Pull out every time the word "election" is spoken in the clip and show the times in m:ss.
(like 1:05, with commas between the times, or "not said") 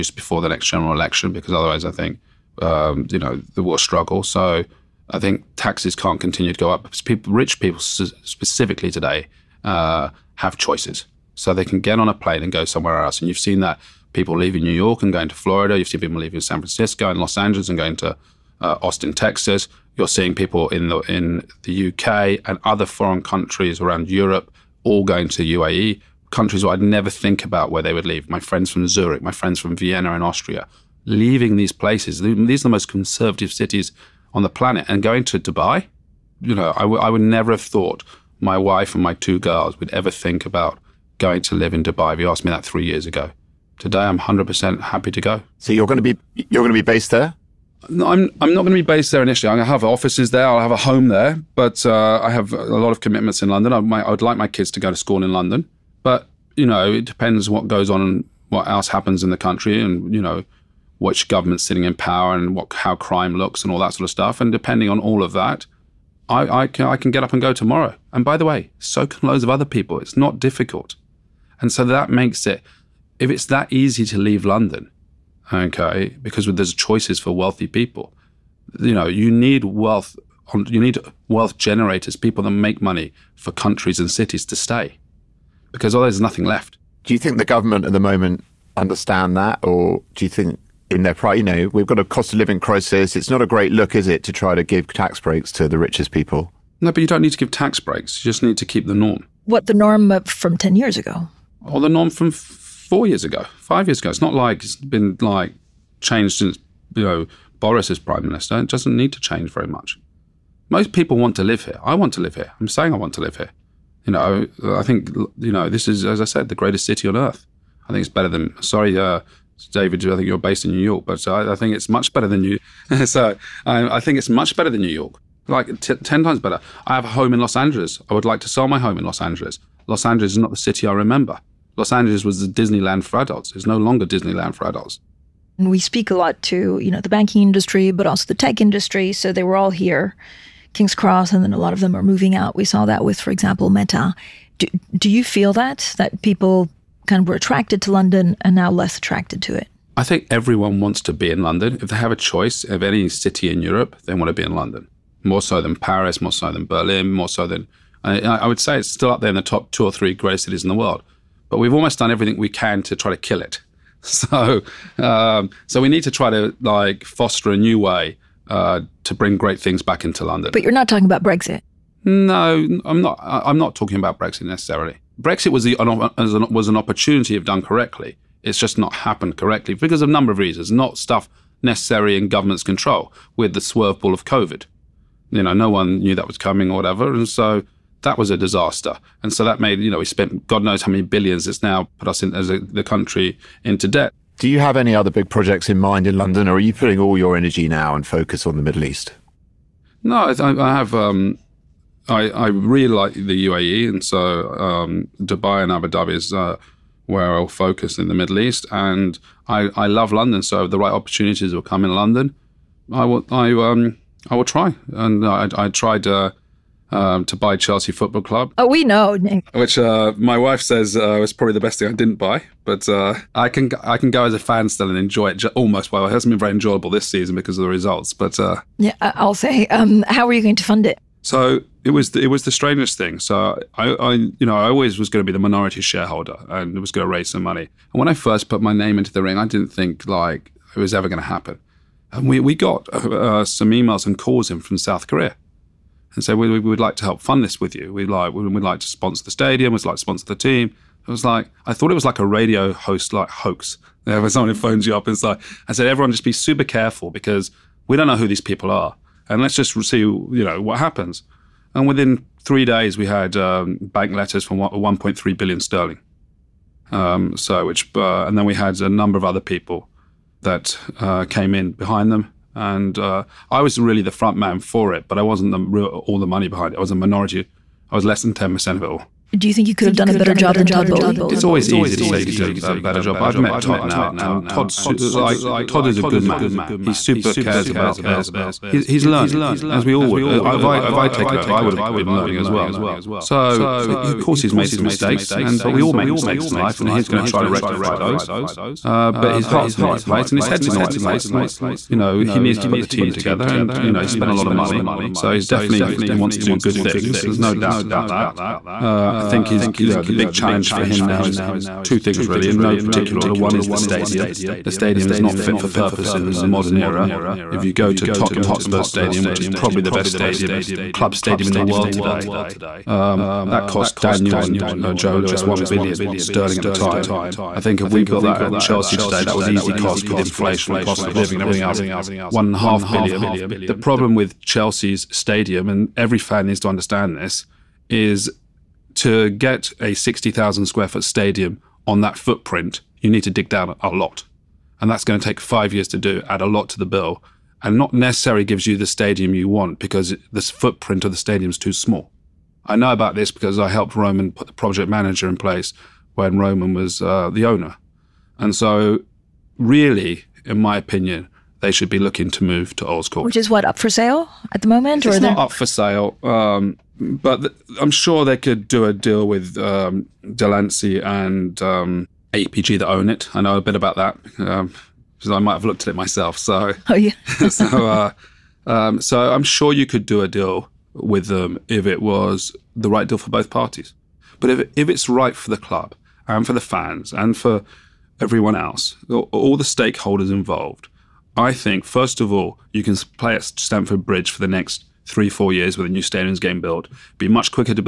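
0:00.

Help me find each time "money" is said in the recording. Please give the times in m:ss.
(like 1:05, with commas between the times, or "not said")
1:22, 3:57, 4:36, 5:04.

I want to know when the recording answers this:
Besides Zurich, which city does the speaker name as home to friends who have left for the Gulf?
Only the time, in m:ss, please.
0:29.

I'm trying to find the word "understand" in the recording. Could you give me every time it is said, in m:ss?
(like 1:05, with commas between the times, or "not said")
1:28, 5:36.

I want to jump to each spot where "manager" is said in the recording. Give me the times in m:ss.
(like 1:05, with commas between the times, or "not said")
5:54.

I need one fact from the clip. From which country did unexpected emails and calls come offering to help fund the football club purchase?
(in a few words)
South Korea.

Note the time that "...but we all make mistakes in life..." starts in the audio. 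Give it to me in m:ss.
4:55.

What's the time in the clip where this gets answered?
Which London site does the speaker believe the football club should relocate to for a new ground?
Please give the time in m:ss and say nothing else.
6:02.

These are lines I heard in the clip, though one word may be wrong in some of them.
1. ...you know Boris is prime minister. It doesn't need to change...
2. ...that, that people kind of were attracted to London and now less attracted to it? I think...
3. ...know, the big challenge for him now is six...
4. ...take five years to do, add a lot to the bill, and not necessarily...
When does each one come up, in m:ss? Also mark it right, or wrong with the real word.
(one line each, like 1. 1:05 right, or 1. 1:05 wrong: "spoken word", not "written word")
1. 1:46 right
2. 2:25 right
3. 5:09 wrong: "two", not "six"
4. 5:45 right.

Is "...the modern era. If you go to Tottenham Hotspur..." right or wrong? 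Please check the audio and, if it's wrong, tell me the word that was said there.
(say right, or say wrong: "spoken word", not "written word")
right.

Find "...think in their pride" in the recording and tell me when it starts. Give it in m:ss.
1:30.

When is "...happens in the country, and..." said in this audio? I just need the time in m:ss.
0:58.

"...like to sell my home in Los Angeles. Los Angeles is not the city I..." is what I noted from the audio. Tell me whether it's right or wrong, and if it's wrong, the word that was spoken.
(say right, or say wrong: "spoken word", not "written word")
right.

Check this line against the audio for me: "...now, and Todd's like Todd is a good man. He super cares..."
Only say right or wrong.
right.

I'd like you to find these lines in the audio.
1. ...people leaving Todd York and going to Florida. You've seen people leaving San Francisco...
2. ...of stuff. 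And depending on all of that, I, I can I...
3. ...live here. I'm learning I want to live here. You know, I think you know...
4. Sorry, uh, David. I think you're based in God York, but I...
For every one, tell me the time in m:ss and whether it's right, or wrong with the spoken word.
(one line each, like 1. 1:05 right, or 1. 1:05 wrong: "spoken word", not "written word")
1. 0:14 wrong: "New", not "Todd"
2. 1:04 right
3. 1:52 wrong: "saying", not "learning"
4. 1:58 wrong: "New", not "God".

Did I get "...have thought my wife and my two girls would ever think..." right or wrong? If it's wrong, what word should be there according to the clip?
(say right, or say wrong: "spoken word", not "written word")
right.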